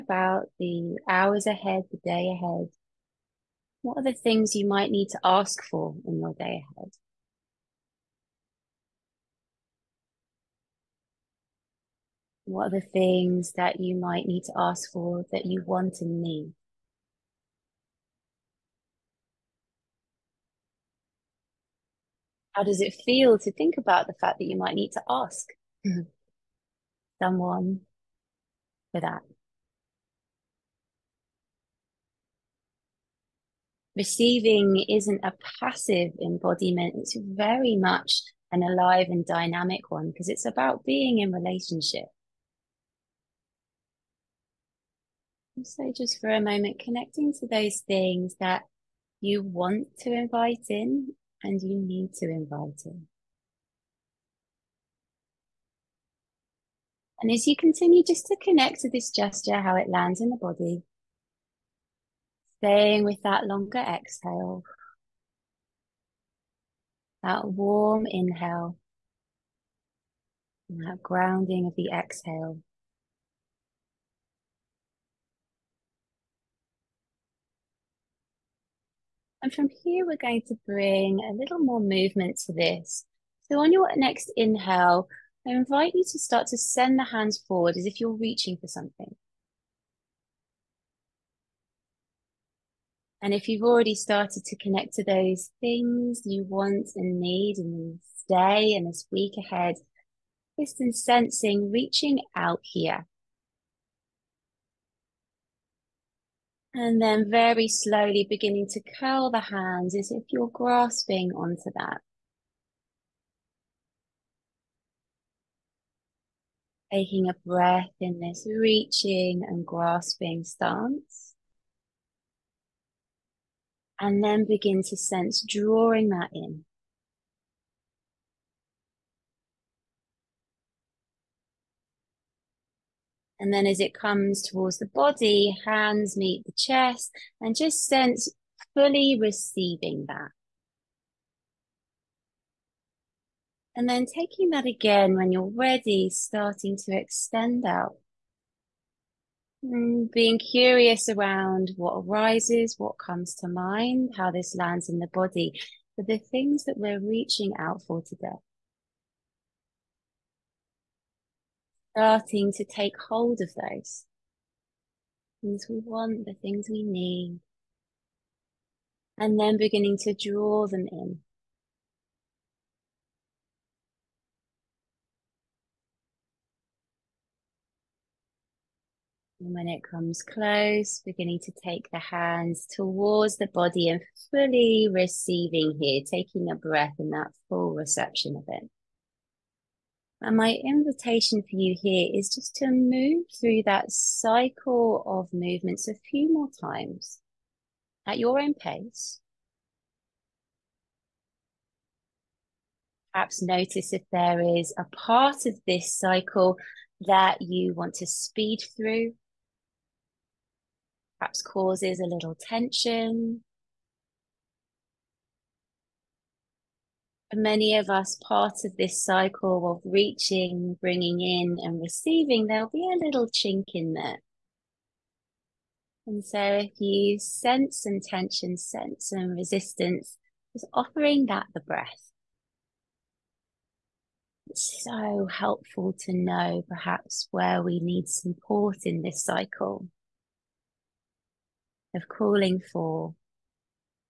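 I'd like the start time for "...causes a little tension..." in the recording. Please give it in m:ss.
3:31.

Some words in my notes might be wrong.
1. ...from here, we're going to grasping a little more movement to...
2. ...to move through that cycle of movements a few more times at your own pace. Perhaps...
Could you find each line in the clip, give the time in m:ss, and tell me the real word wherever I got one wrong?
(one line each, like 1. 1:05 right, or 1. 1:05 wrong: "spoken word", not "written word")
1. 1:19 wrong: "bring", not "grasping"
2. 3:12 right.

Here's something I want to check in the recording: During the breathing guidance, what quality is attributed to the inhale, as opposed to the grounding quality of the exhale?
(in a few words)
warm.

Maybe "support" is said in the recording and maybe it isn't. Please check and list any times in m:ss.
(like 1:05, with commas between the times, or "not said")
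3:58.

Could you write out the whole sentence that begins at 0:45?
So, just for a moment, connecting to those things that you want to invite in and you need to invite it.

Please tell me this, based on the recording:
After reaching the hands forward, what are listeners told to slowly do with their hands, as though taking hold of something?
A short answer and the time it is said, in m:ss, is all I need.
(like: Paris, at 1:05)
curl the hands, at 1:48.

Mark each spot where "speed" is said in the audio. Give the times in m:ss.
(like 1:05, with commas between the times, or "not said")
3:28.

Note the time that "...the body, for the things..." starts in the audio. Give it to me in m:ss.
2:35.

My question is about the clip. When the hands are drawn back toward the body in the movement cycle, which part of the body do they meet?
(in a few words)
the chest.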